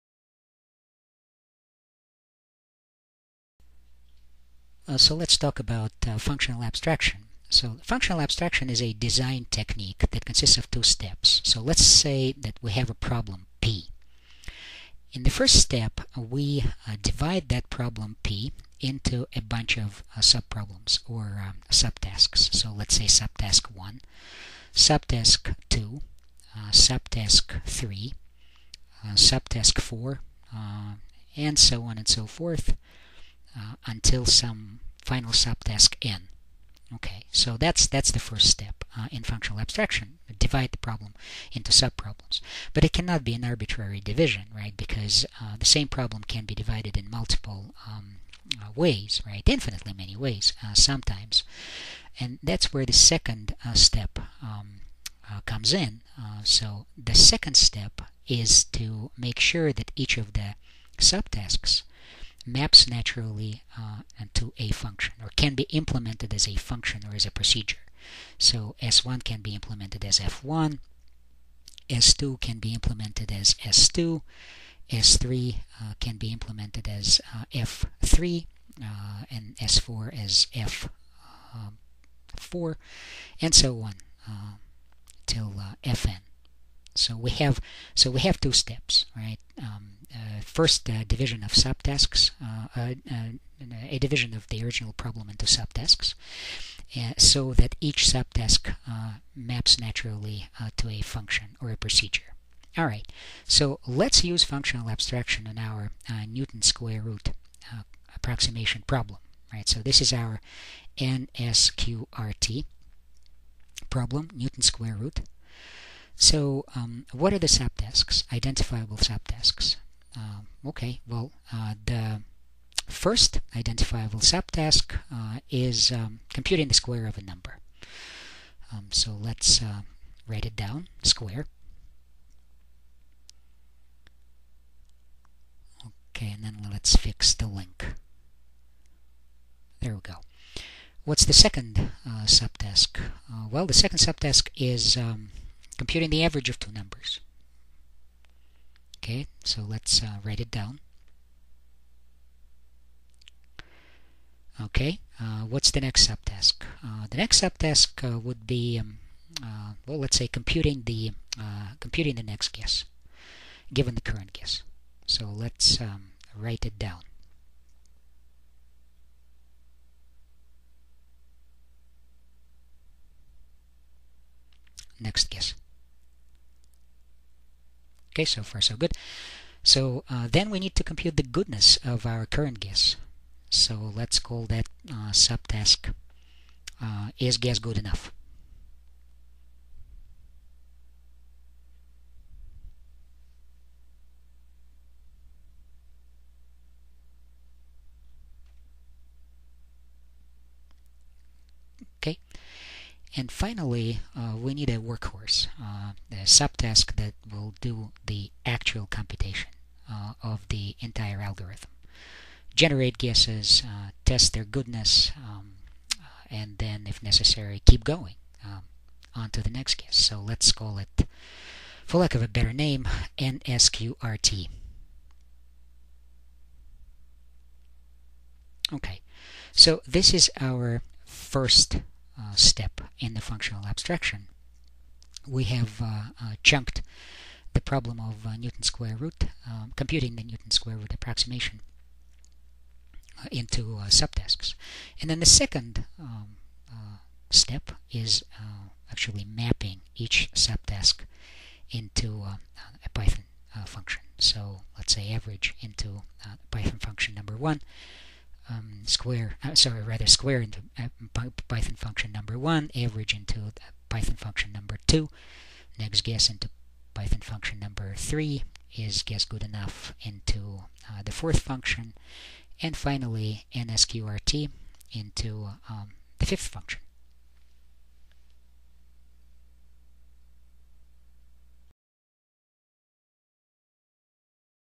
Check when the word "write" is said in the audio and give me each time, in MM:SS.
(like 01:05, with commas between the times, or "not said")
02:10, 02:30, 02:46.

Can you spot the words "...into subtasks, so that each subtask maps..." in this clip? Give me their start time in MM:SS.
01:35.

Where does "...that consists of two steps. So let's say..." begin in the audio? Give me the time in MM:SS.
00:10.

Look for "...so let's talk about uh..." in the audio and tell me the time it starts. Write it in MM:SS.
00:04.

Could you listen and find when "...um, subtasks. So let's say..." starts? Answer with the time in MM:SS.
00:21.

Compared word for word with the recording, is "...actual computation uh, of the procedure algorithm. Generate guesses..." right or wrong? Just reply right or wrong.
wrong.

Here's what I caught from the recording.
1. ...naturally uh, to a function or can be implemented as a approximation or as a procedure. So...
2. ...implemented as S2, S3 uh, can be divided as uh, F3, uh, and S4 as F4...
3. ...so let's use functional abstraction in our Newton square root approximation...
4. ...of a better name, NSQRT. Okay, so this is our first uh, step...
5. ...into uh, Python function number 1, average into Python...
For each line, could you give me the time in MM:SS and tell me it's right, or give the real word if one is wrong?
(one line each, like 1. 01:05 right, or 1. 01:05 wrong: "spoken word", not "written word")
1. 01:02 wrong: "function", not "approximation"
2. 01:12 wrong: "implemented", not "divided"
3. 01:43 right
4. 03:42 right
5. 04:20 right.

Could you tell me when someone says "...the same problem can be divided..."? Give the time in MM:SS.
00:45.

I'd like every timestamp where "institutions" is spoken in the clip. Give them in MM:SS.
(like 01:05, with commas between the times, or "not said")
not said.